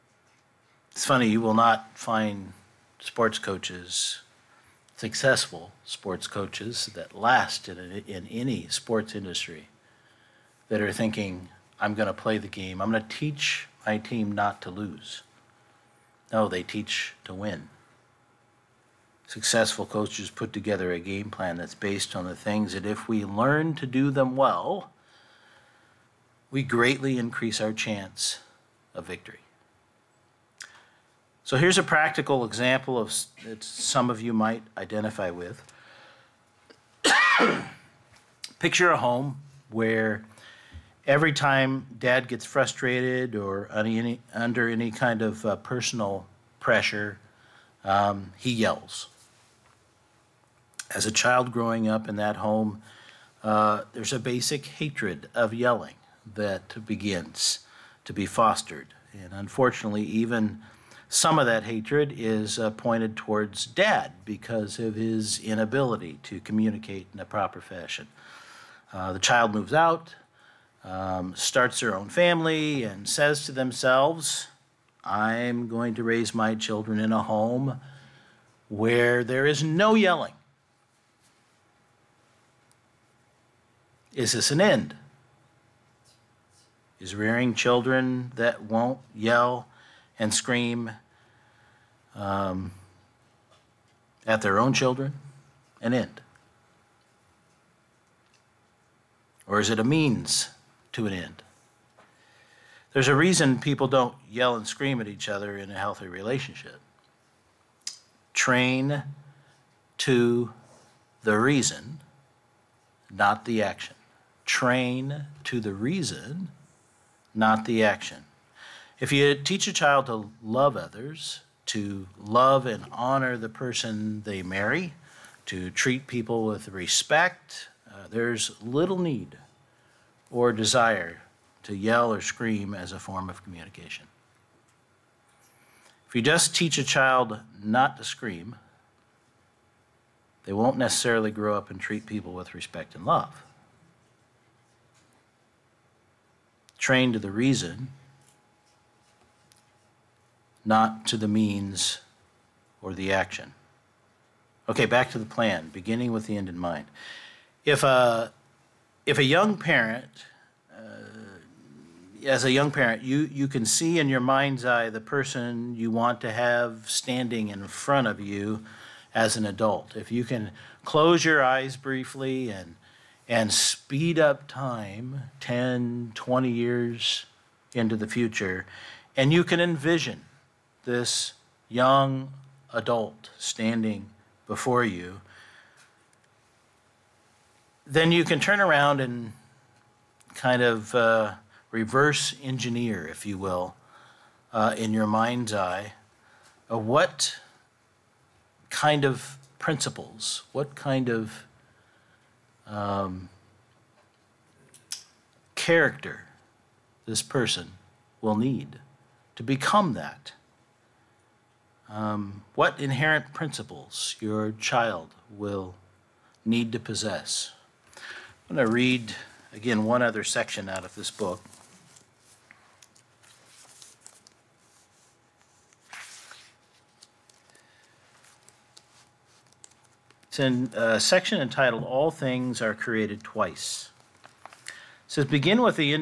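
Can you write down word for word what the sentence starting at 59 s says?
And unfortunately, even some of that hatred is uh, pointed towards dad because of his inability to communicate in a proper fashion.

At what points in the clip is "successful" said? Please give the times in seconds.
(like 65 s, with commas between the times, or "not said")
4 s, 19 s.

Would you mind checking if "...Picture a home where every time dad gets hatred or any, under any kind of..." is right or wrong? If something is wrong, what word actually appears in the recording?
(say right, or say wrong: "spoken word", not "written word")
wrong: "frustrated", not "hatred".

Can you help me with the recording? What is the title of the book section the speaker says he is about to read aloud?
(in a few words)
All Things Are Created Twice.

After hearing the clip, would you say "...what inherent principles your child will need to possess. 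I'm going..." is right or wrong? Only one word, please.
right.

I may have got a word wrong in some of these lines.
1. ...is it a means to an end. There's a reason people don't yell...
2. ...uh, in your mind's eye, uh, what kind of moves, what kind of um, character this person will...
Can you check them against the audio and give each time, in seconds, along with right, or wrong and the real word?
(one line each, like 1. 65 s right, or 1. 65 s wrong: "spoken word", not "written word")
1. 99 s right
2. 194 s wrong: "principles", not "moves".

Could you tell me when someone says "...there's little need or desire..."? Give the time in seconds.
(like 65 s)
128 s.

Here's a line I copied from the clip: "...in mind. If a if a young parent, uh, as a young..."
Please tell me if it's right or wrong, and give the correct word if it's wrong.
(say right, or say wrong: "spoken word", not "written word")
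right.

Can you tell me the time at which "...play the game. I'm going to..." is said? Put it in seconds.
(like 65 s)
12 s.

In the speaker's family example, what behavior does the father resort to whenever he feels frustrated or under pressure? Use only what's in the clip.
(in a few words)
He yells.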